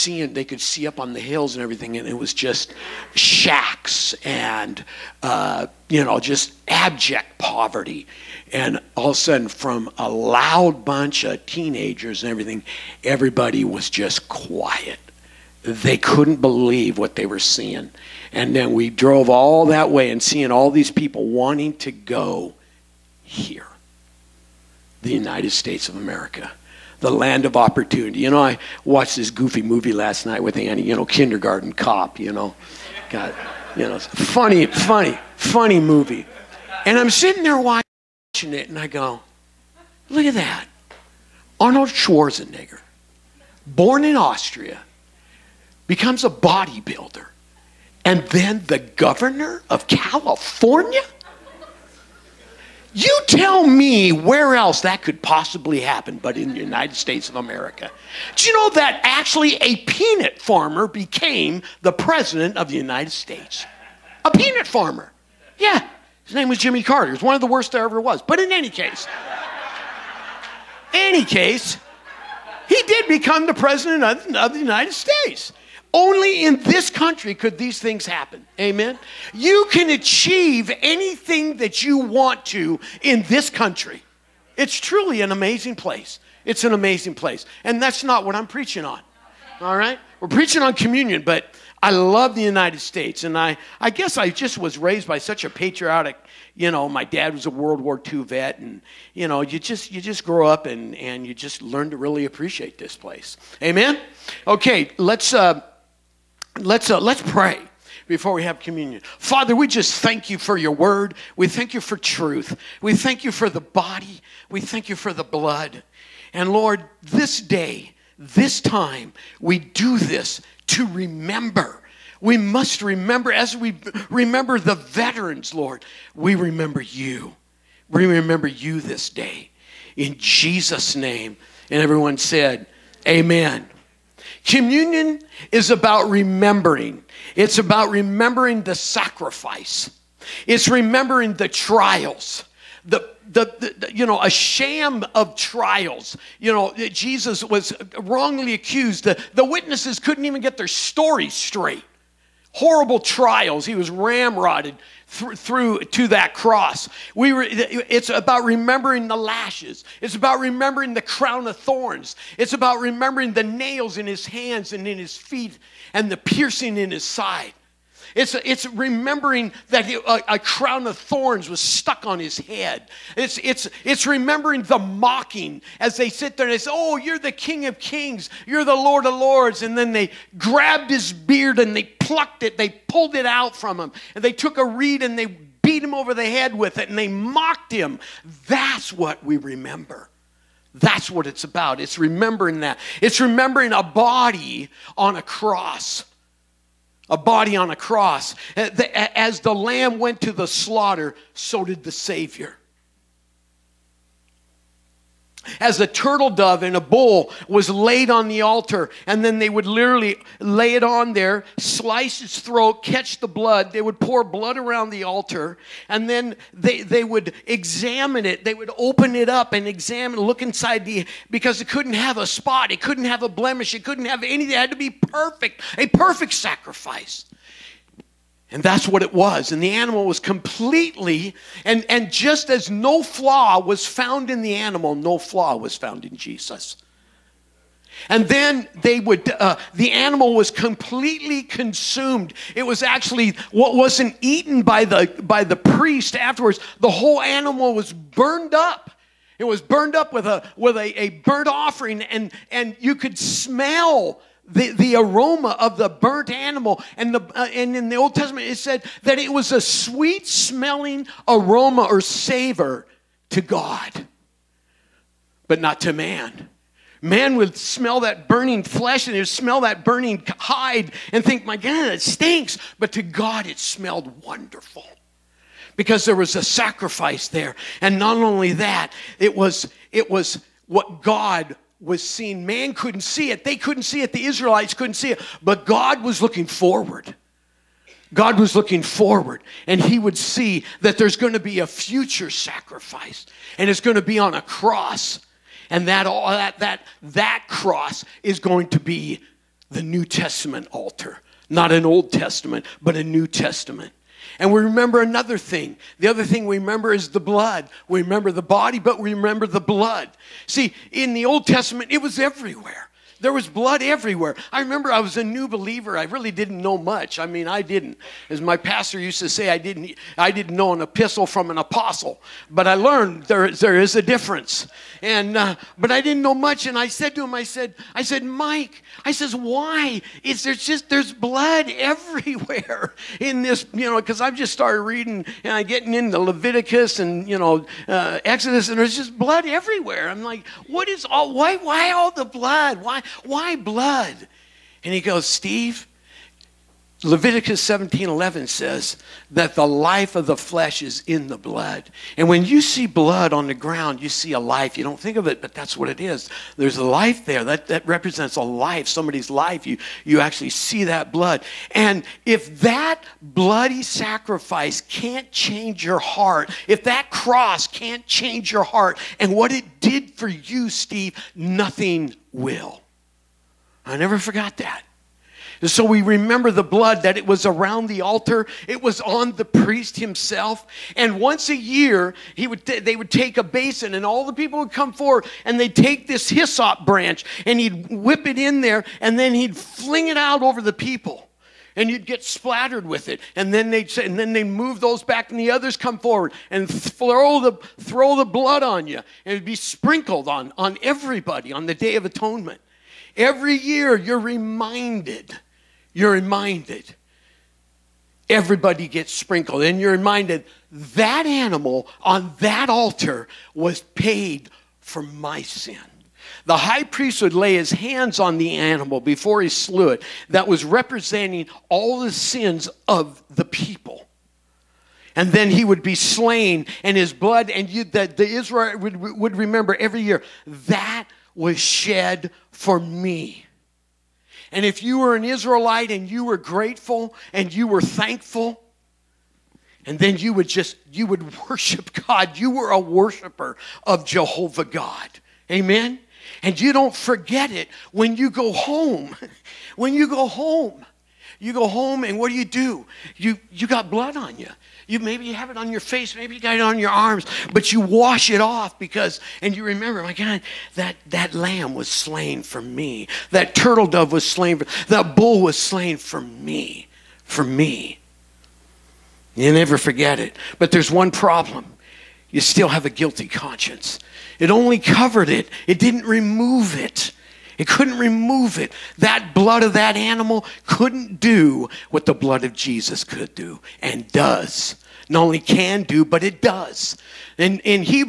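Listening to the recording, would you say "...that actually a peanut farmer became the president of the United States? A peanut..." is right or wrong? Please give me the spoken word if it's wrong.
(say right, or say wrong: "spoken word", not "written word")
right.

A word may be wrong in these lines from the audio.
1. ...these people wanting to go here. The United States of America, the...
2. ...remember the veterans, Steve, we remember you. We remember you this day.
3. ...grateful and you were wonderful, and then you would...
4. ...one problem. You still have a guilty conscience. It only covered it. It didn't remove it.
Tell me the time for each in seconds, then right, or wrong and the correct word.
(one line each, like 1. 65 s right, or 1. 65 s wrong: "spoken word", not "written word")
1. 20 s right
2. 124 s wrong: "Lord", not "Steve"
3. 436 s wrong: "thankful", not "wonderful"
4. 470 s right.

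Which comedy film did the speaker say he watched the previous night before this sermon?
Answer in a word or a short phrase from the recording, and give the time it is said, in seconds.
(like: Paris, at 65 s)
Kindergarten Cop, at 31 s.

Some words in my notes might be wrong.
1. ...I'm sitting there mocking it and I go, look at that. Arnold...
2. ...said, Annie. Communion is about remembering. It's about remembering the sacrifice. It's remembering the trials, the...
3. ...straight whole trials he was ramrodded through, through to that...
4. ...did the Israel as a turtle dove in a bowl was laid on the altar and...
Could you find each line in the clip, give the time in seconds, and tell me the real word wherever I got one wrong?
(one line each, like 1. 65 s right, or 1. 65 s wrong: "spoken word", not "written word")
1. 36 s wrong: "watching", not "mocking"
2. 132 s wrong: "Amen", not "Annie"
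3. 151 s wrong: "horrible", not "whole"
4. 201 s wrong: "Savior", not "Israel".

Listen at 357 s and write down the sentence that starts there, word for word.
That, that represents a life, somebody's life.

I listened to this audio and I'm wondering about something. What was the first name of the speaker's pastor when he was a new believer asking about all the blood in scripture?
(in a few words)
Mike.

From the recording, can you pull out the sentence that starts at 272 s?
But to God, it smelled wonderful because there was a sacrifice there.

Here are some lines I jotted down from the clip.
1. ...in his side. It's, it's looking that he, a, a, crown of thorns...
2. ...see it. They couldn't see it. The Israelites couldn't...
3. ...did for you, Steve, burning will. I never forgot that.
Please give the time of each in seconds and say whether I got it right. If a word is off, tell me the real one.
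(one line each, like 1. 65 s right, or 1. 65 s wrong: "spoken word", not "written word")
1. 166 s wrong: "remembering", not "looking"
2. 283 s right
3. 369 s wrong: "nothing", not "burning".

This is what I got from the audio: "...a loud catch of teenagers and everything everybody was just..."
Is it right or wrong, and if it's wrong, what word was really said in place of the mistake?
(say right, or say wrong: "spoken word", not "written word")
wrong: "bunch", not "catch".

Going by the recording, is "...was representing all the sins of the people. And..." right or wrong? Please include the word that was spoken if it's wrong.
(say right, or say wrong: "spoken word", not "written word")
right.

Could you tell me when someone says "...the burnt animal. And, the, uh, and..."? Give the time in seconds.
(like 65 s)
255 s.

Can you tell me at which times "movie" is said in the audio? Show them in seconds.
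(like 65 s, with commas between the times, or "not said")
29 s, 35 s.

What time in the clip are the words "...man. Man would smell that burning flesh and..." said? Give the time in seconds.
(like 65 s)
265 s.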